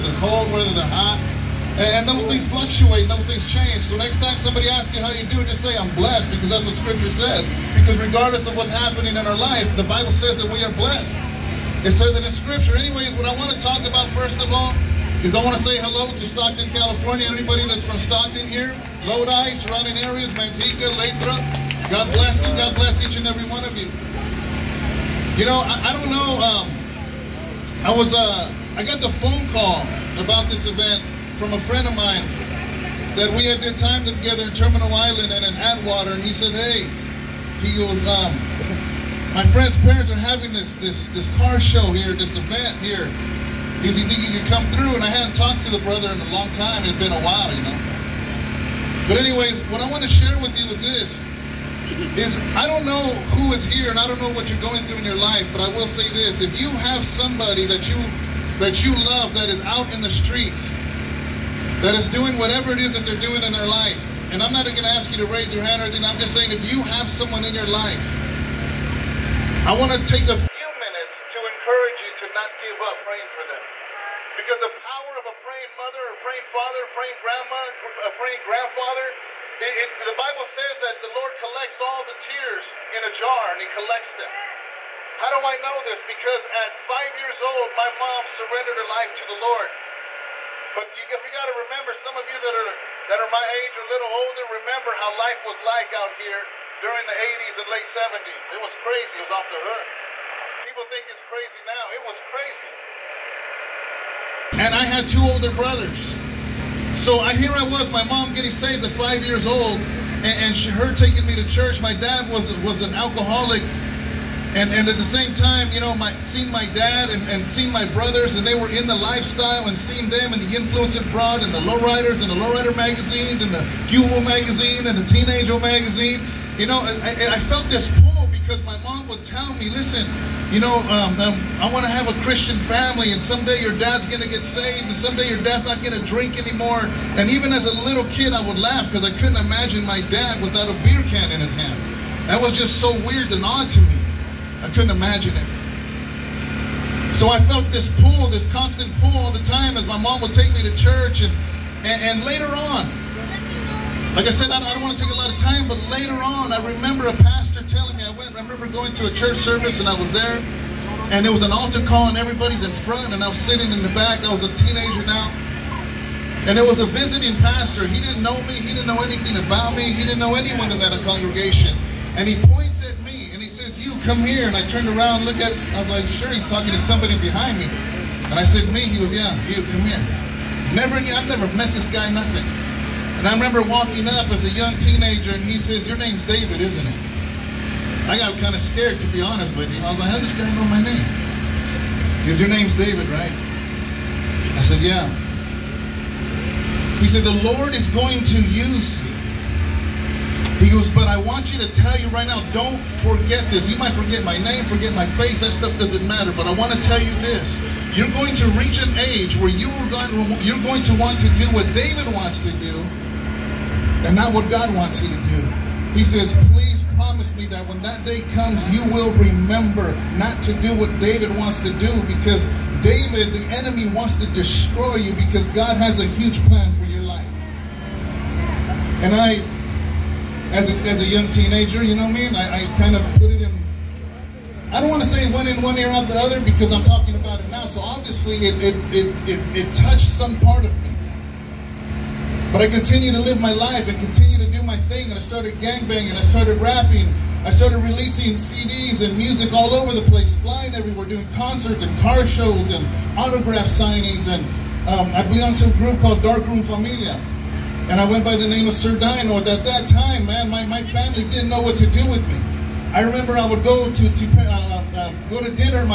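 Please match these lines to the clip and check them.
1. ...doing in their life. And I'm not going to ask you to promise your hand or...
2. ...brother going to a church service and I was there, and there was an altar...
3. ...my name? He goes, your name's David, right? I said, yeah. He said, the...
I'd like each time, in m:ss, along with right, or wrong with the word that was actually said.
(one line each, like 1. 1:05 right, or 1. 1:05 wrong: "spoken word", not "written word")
1. 1:03 wrong: "raise", not "promise"
2. 2:38 wrong: "remember", not "brother"
3. 3:10 right.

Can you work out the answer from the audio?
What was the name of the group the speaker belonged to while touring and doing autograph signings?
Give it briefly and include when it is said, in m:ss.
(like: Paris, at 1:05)
Dark Room Familia, at 4:16.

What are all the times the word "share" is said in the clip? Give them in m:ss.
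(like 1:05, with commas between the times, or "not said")
0:50.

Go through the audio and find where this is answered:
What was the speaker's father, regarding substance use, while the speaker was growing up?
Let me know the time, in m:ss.
1:52.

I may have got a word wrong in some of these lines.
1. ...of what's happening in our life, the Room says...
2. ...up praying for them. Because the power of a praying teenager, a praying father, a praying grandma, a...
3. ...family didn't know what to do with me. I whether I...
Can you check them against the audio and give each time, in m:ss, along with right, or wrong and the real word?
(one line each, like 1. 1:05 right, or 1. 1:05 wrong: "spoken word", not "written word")
1. 0:08 wrong: "Bible", not "Room"
2. 1:12 wrong: "mother", not "teenager"
3. 4:20 wrong: "remember", not "whether".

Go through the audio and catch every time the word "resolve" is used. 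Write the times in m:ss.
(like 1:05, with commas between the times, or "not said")
not said.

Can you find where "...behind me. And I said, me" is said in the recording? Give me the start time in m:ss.
2:57.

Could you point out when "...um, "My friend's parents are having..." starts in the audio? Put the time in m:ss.
0:38.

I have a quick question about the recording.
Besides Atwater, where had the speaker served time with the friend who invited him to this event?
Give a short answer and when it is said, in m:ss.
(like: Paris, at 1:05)
Terminal Island, at 0:34.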